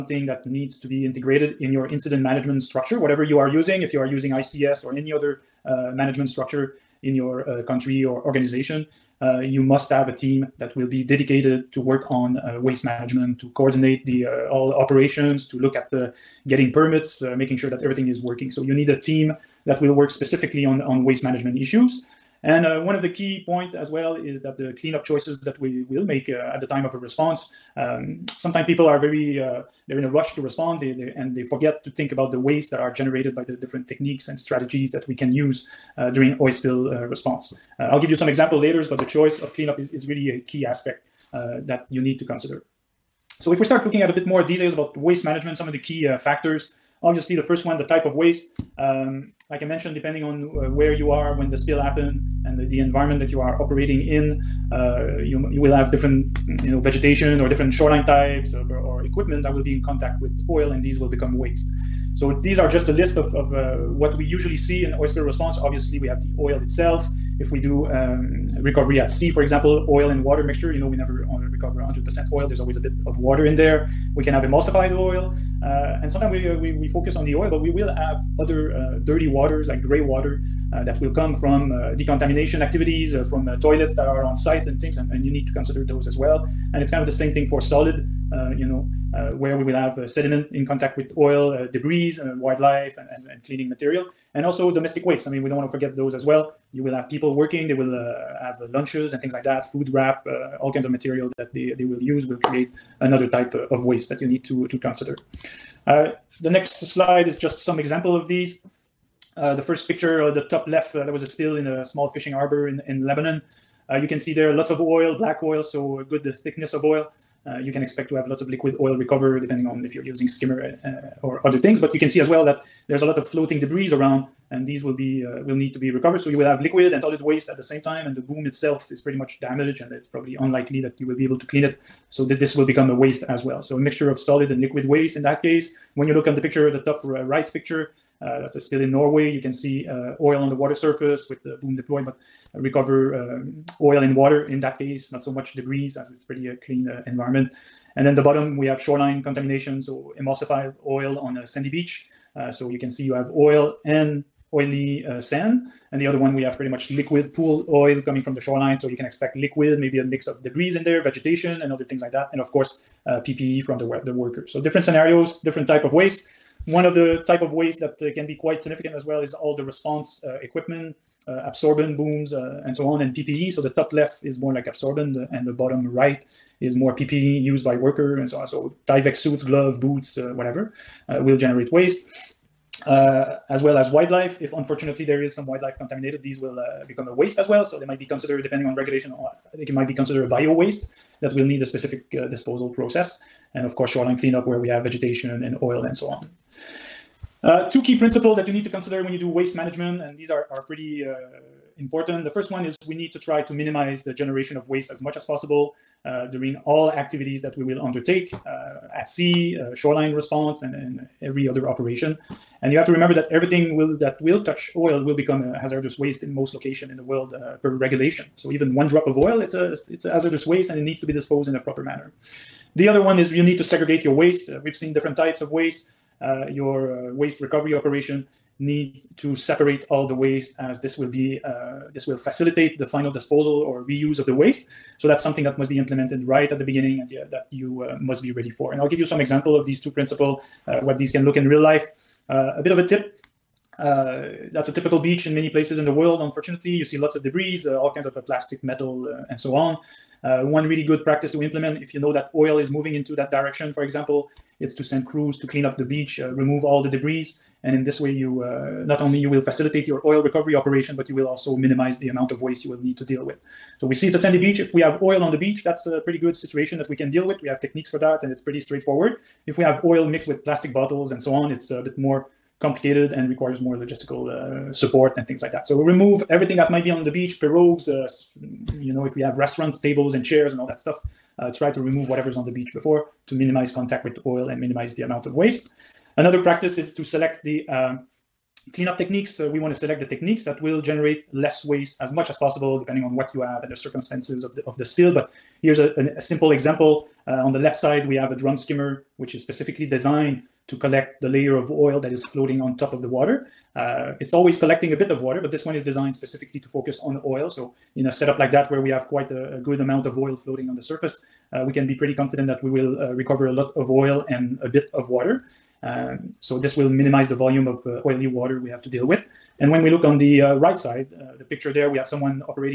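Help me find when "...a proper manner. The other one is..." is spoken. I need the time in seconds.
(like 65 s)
221 s.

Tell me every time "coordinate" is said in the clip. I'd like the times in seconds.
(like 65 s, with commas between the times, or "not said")
13 s.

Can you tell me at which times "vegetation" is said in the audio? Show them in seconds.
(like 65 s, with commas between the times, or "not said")
56 s, 161 s, 194 s.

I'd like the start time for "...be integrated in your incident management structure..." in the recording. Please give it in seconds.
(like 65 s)
0 s.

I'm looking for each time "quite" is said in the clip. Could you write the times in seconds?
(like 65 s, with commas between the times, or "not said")
168 s, 309 s.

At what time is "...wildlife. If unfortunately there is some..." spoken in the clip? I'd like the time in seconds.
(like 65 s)
183 s.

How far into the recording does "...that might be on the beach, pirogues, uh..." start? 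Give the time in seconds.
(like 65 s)
276 s.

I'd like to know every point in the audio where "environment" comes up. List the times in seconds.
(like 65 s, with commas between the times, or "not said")
52 s, 147 s.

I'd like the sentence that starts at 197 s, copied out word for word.
Uh, two key principles that you need to consider when you do waste management, and these are, are pretty uh, important.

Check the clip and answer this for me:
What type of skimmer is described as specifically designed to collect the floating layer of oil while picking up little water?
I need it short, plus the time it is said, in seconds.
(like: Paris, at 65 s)
drum skimmer, at 298 s.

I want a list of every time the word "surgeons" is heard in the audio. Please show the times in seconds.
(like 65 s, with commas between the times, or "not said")
not said.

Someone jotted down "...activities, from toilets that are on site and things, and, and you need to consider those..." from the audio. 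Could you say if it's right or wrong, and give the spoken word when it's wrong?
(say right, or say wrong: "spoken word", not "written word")
right.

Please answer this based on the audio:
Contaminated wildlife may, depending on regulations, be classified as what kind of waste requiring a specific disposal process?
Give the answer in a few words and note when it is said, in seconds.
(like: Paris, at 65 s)
bio waste, at 190 s.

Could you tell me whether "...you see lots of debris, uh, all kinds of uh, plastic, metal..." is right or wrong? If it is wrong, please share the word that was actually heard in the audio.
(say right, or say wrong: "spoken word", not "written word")
right.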